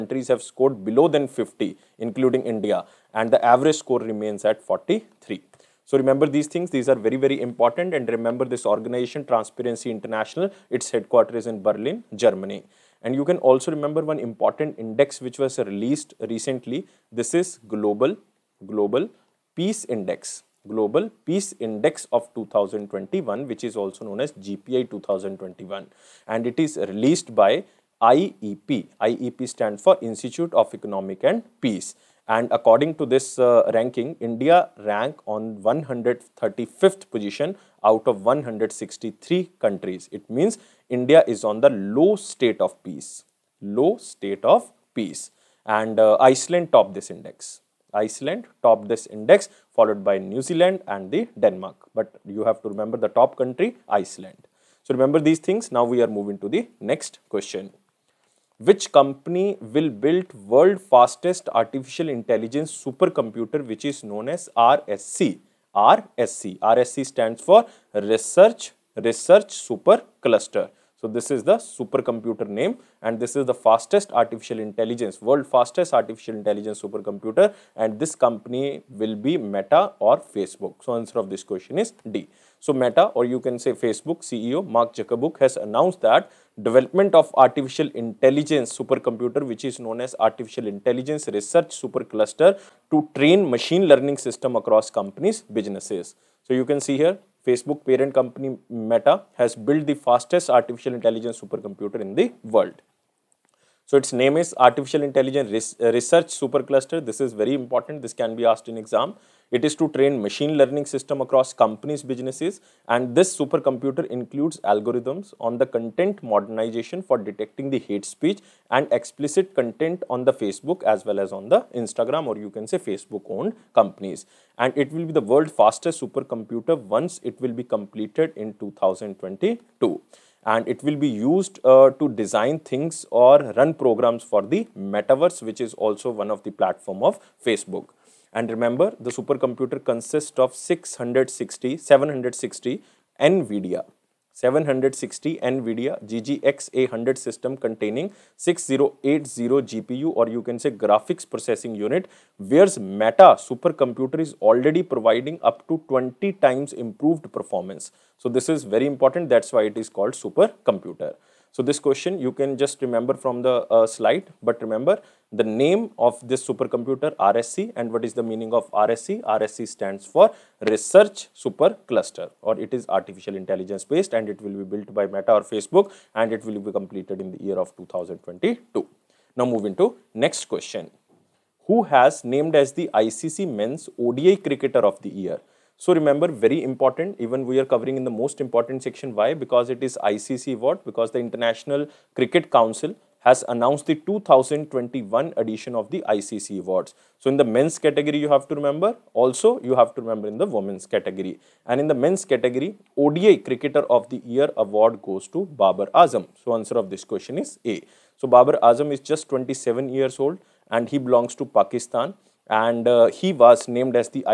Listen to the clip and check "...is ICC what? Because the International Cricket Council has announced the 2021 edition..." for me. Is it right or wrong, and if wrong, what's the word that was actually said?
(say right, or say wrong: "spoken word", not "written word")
right.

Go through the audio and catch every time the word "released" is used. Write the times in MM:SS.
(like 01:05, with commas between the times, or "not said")
00:15, 00:26.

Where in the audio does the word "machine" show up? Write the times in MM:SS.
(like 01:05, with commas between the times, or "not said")
01:33, 01:50.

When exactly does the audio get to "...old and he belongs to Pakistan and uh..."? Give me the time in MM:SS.
03:30.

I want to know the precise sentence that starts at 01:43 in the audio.
So its name is Artificial Intelligence uh, Research Supercluster.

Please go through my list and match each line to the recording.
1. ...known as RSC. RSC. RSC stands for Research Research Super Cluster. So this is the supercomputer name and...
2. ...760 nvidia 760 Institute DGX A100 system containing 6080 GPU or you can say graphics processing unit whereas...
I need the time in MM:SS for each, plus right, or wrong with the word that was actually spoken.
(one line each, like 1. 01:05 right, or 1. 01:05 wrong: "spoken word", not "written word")
1. 01:04 right
2. 02:21 wrong: "NVIDIA", not "Institute".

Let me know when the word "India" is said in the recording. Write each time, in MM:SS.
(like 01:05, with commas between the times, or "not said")
00:02, 00:34, 00:40.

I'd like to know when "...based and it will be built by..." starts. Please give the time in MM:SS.
02:53.